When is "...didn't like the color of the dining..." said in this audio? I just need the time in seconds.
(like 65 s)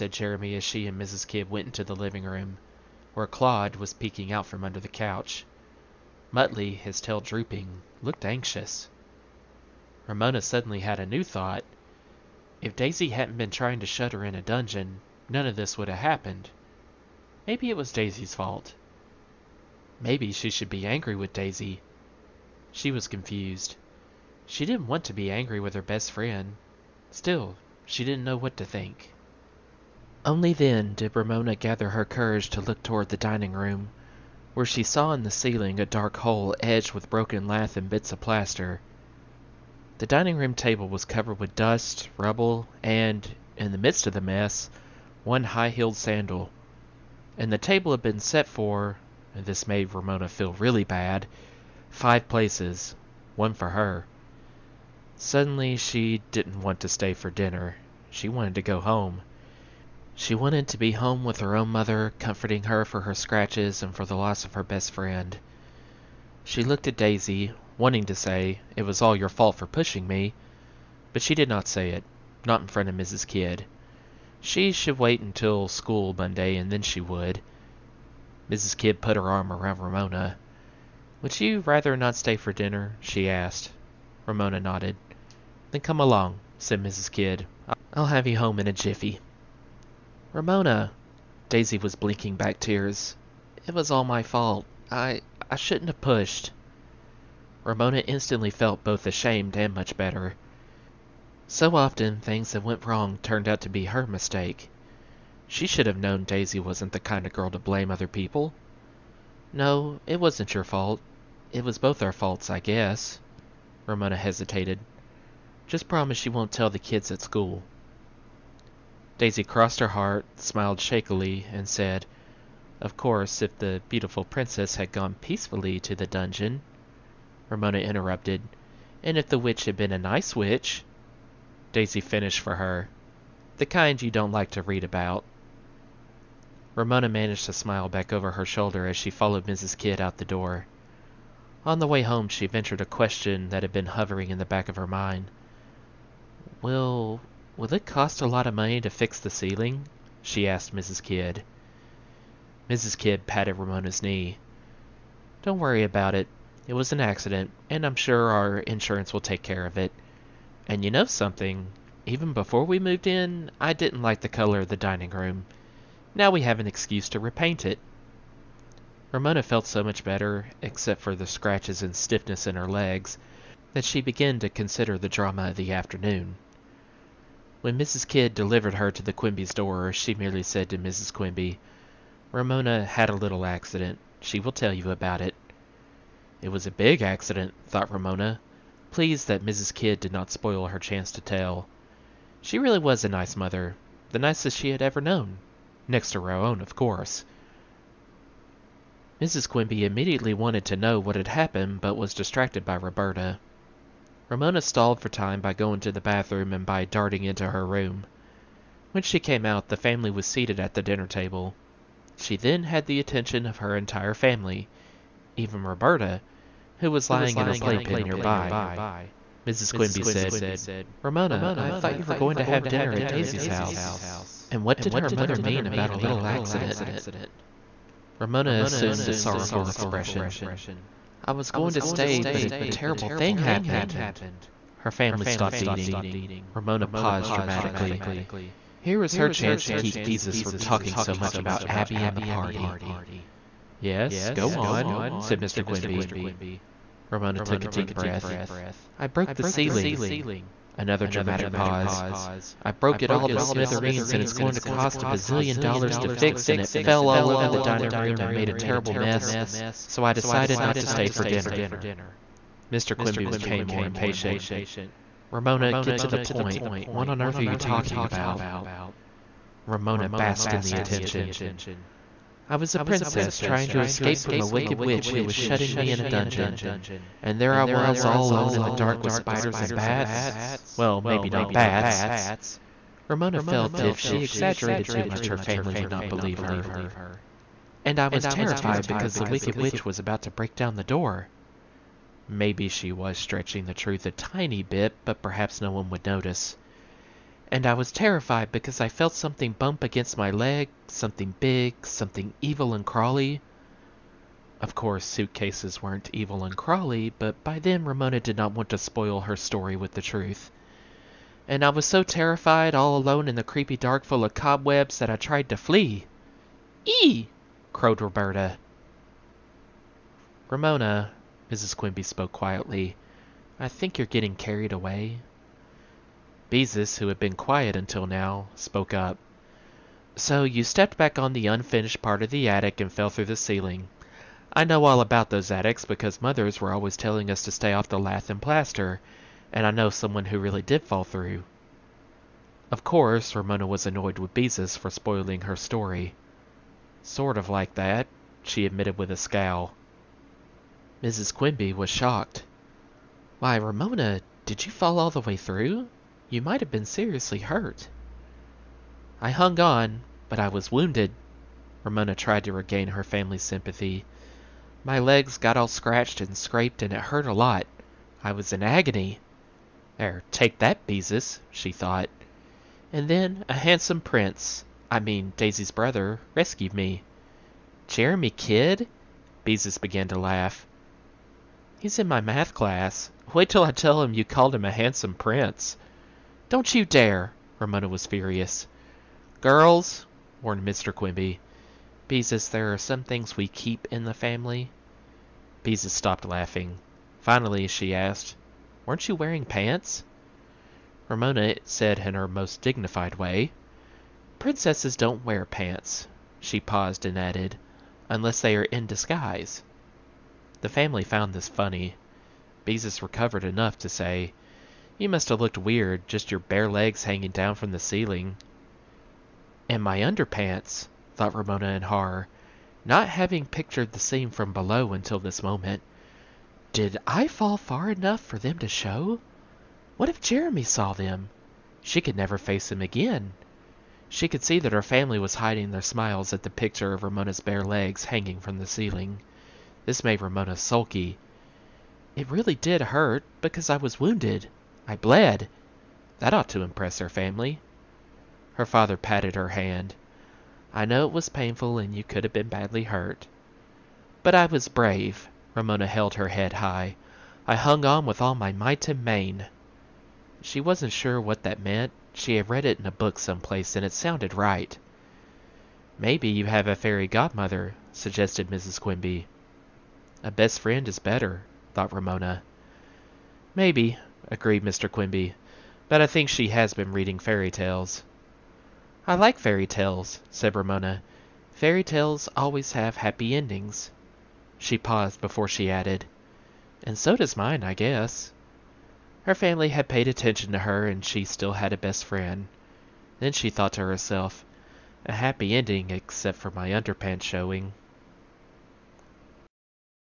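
163 s.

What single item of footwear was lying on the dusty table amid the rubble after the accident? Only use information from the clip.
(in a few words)
high heeled sandal.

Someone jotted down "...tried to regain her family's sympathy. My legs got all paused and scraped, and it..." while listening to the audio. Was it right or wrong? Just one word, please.
wrong.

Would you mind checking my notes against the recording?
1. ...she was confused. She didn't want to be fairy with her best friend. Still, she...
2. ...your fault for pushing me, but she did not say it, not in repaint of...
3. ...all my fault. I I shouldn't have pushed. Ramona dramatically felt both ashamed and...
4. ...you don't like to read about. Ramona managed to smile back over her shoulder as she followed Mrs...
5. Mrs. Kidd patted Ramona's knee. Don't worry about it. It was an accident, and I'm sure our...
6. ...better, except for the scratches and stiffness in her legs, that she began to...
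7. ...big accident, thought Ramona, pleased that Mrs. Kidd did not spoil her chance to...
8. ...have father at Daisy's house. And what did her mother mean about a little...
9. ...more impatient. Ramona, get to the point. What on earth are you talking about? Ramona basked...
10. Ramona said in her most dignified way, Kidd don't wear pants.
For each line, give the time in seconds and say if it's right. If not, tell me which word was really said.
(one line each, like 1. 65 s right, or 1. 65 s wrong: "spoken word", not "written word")
1. 22 s wrong: "angry", not "fairy"
2. 69 s wrong: "front", not "repaint"
3. 93 s wrong: "instantly", not "dramatically"
4. 134 s right
5. 152 s right
6. 170 s right
7. 186 s right
8. 222 s wrong: "dinner", not "father"
9. 263 s right
10. 401 s wrong: "Princesses", not "Kidd".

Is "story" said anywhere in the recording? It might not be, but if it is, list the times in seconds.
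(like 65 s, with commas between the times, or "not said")
309 s, 345 s.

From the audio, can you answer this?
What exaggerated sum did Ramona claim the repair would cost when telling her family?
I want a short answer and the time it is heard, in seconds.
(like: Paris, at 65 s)
a bazillion dollars, at 255 s.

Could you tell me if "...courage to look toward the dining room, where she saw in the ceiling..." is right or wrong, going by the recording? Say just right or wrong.
right.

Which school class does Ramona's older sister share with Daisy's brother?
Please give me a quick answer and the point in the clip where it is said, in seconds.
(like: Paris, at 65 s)
math, at 382 s.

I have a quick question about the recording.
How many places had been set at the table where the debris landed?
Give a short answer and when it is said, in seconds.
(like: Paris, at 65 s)
5, at 51 s.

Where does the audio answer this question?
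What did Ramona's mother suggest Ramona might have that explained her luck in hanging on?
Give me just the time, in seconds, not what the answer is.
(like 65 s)
466 s.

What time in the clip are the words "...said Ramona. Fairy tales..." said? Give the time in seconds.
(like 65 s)
480 s.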